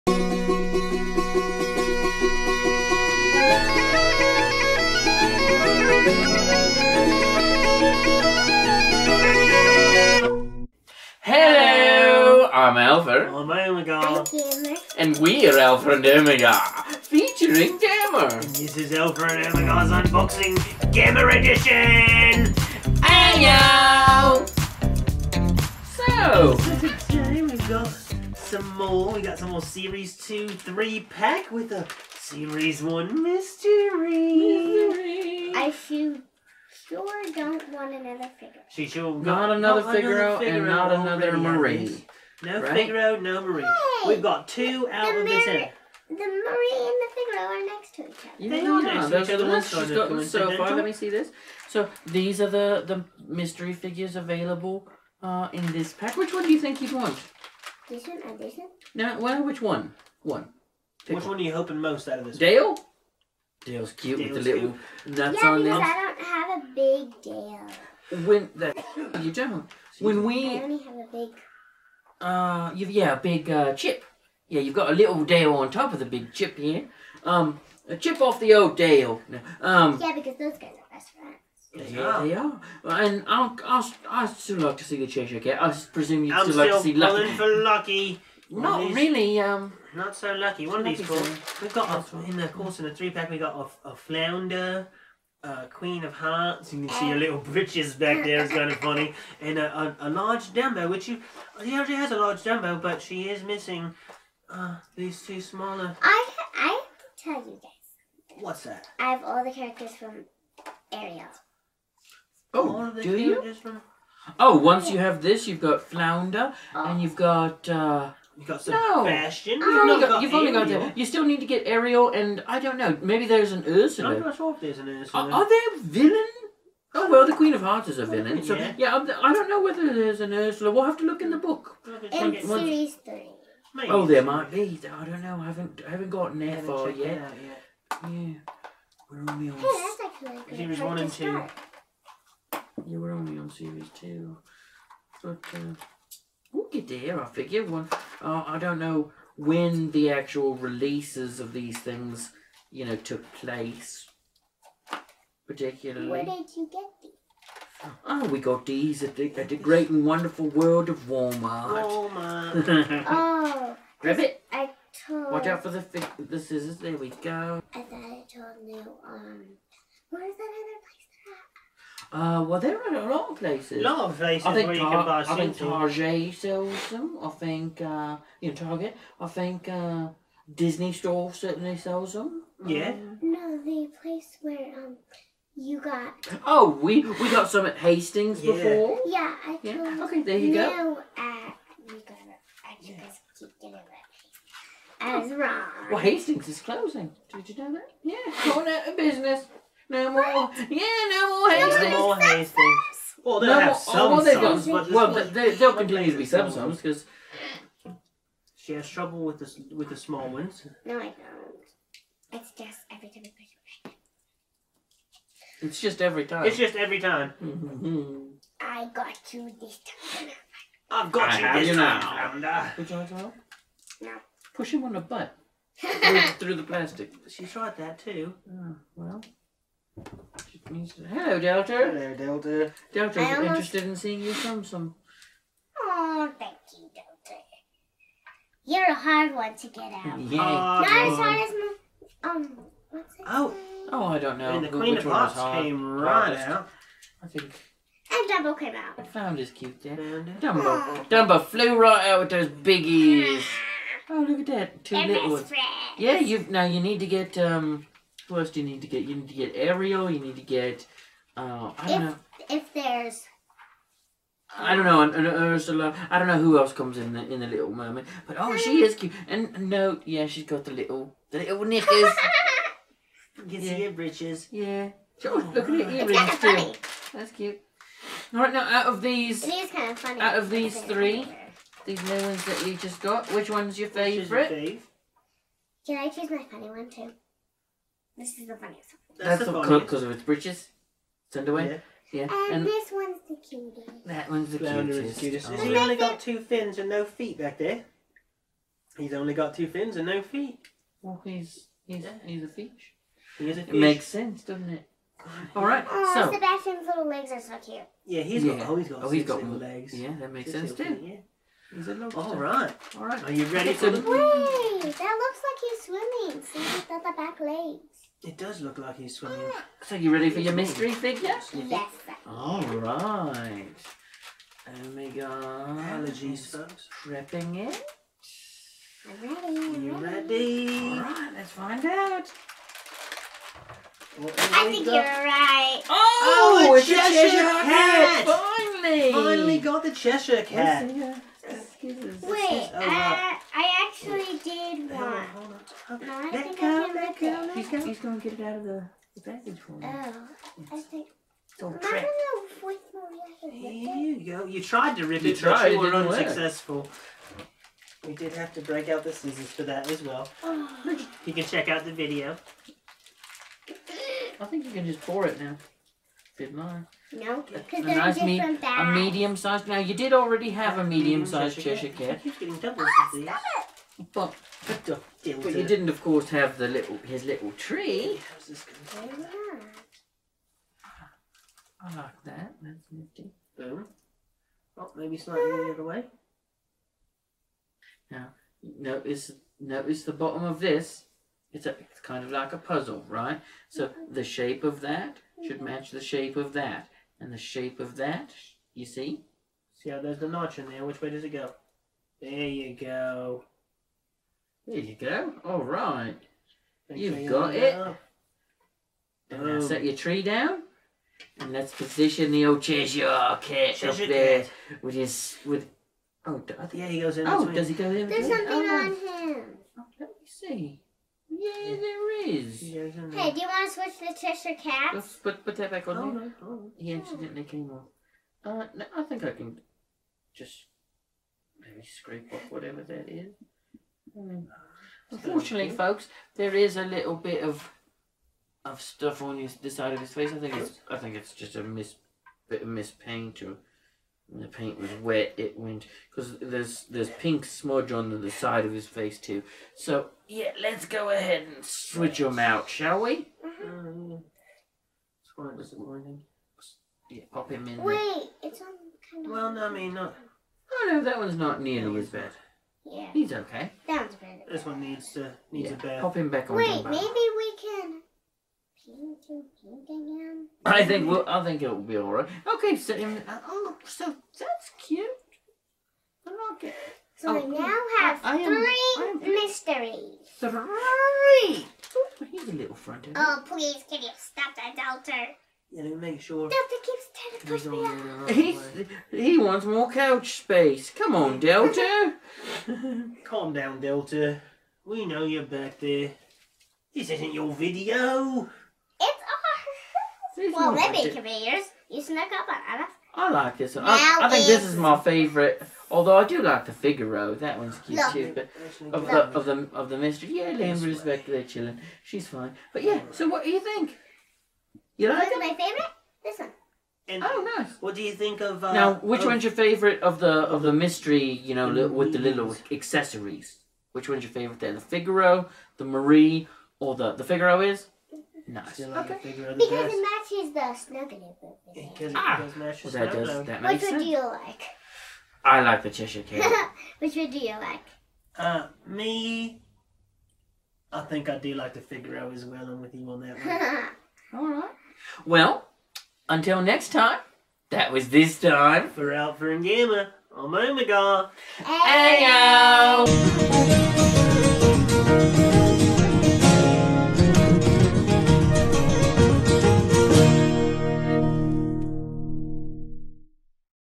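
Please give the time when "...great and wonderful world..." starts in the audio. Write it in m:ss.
2:39.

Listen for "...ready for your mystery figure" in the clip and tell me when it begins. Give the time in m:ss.
5:20.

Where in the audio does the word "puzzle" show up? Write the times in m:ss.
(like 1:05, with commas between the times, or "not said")
6:32.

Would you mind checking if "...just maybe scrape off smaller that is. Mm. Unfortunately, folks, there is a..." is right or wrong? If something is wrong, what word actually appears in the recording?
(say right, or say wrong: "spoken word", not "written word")
wrong: "whatever", not "smaller".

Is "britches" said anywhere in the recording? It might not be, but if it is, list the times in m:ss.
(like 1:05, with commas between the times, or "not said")
1:37, 4:50.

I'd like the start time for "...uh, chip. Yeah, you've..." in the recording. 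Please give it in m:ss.
1:13.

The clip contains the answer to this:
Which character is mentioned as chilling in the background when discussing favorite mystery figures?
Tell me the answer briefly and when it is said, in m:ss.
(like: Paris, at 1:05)
Lambert, at 8:30.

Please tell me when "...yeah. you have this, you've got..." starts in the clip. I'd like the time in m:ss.
1:54.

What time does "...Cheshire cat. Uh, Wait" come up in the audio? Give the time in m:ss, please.
5:39.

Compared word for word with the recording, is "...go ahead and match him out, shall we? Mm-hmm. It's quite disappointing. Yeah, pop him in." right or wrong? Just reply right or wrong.
wrong.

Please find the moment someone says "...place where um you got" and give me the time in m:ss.
3:04.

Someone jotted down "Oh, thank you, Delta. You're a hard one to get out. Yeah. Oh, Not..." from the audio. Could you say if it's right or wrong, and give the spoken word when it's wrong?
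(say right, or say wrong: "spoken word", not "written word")
right.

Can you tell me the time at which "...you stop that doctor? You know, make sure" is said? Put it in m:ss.
8:04.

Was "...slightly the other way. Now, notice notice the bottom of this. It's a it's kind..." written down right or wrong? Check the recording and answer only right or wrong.
right.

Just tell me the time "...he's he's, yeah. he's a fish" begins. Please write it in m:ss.
5:01.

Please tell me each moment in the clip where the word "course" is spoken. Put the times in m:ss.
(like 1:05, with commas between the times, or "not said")
1:32, 6:16.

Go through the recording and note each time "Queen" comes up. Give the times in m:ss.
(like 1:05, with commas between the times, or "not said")
1:35, 2:07, 4:04.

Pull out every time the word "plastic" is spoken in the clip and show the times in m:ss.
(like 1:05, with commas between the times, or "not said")
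3:46.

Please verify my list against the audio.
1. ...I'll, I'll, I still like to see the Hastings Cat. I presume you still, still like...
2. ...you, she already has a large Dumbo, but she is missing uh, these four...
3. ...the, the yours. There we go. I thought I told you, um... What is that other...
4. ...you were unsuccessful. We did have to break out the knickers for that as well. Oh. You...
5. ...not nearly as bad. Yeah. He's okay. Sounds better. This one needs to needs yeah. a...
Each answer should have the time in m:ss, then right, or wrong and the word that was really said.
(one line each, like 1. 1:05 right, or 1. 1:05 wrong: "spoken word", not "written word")
1. 1:23 wrong: "Cheshire", not "Hastings"
2. 1:41 wrong: "two", not "four"
3. 2:45 wrong: "scissors", not "yours"
4. 5:55 wrong: "scissors", not "knickers"
5. 7:41 right.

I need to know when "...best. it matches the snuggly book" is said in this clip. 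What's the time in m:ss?
8:49.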